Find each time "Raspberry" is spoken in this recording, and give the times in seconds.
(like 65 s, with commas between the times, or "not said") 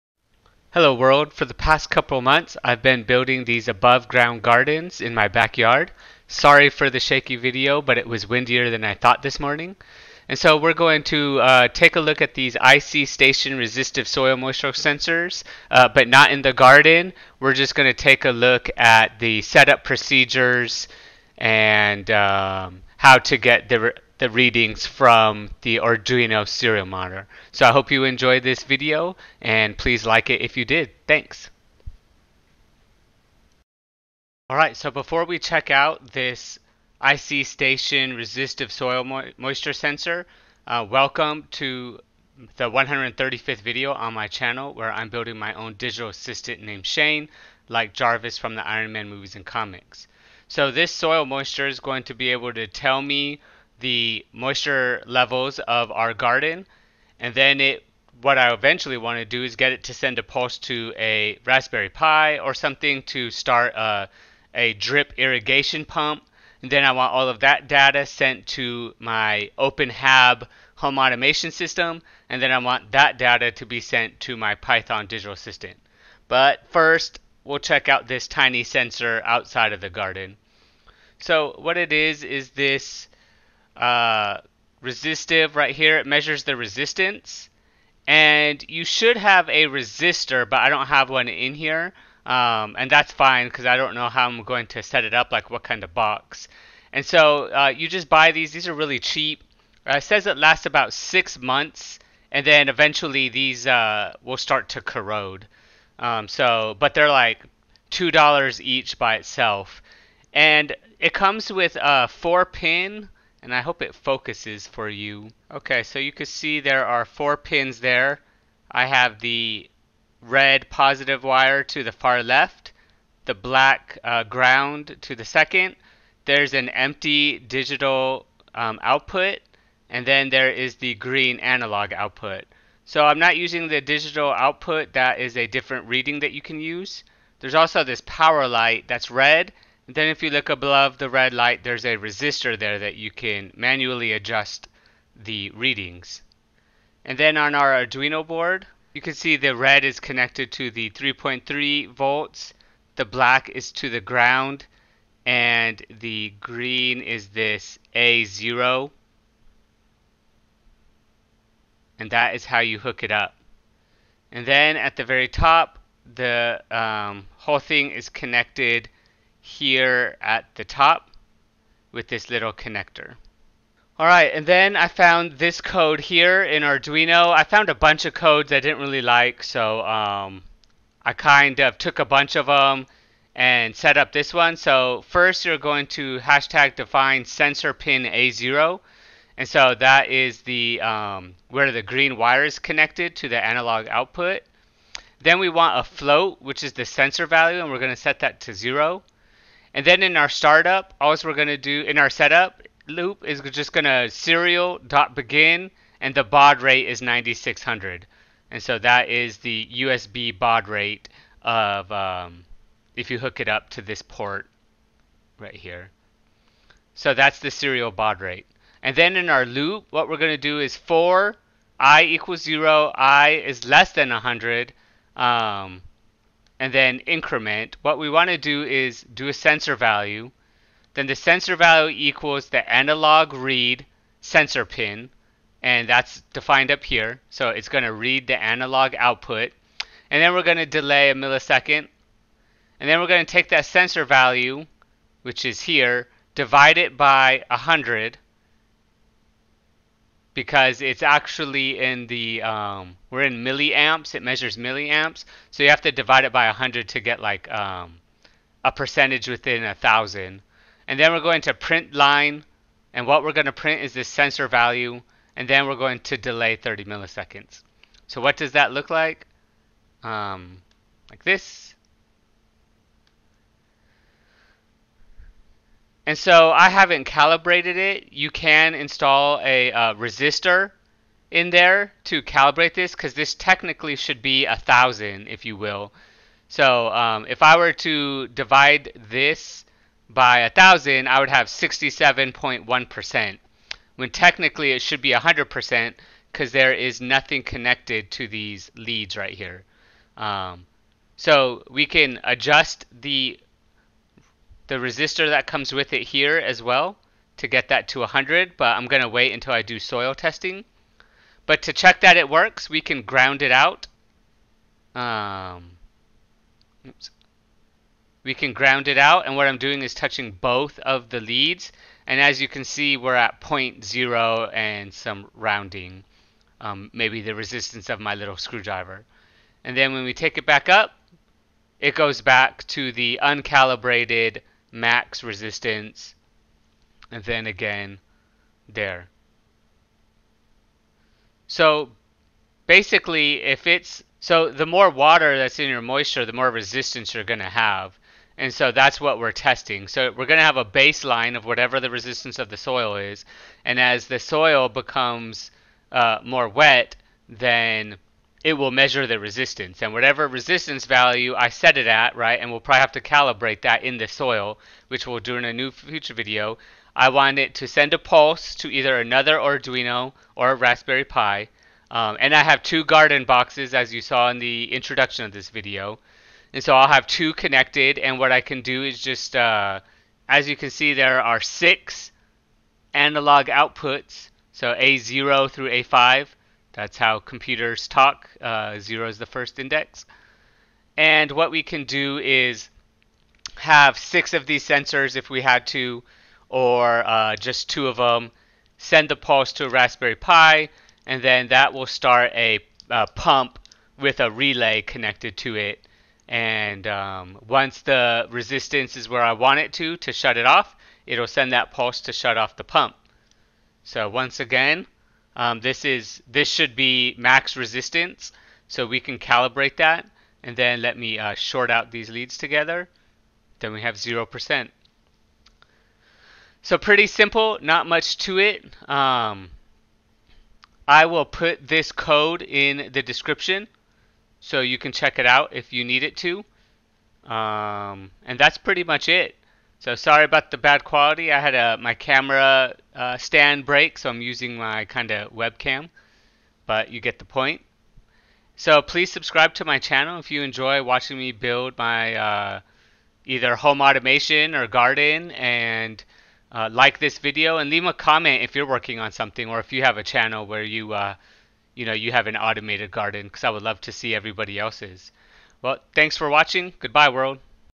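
61 s, 370 s, 399 s.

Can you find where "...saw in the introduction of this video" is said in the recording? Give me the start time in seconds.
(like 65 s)
374 s.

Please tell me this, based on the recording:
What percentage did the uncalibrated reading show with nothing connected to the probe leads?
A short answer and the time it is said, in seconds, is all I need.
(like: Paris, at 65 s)
67.1%, at 291 s.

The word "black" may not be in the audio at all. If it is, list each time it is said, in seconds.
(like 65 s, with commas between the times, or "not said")
123 s, 153 s.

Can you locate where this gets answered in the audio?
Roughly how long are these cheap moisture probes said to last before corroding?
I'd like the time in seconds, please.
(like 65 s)
100 s.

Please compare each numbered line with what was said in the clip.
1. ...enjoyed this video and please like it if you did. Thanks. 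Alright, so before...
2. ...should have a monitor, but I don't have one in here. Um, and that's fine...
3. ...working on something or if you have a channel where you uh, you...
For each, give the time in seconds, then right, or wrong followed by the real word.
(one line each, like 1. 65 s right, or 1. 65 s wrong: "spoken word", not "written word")
1. 28 s right
2. 88 s wrong: "resistor", not "monitor"
3. 458 s right.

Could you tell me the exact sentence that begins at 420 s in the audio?
And then let me uh, short out these leads together.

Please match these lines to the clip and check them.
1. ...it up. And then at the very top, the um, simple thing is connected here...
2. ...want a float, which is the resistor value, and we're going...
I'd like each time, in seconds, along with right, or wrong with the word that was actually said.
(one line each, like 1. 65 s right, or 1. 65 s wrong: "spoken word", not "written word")
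1. 163 s wrong: "whole", not "simple"
2. 195 s wrong: "sensor", not "resistor".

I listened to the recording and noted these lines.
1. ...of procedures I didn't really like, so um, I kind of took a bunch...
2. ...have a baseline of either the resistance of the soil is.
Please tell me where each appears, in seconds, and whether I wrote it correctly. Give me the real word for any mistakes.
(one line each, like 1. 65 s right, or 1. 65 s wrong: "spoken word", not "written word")
1. 178 s wrong: "codes", not "procedures"
2. 350 s wrong: "whatever", not "either".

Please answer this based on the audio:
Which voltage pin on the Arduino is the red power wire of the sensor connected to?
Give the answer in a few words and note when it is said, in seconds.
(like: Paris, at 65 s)
3.3 volts, at 150 s.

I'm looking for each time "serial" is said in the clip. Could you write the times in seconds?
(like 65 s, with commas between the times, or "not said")
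26 s, 204 s, 217 s.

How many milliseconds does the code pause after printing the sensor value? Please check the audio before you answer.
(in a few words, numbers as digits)
30.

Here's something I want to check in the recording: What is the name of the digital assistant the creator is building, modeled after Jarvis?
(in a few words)
Shane.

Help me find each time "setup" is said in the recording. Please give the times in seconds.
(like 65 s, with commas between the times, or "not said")
19 s, 202 s.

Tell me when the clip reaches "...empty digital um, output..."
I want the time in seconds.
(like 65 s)
126 s.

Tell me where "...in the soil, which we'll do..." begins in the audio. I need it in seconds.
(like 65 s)
363 s.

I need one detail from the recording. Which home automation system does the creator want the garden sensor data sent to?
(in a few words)
OpenHab.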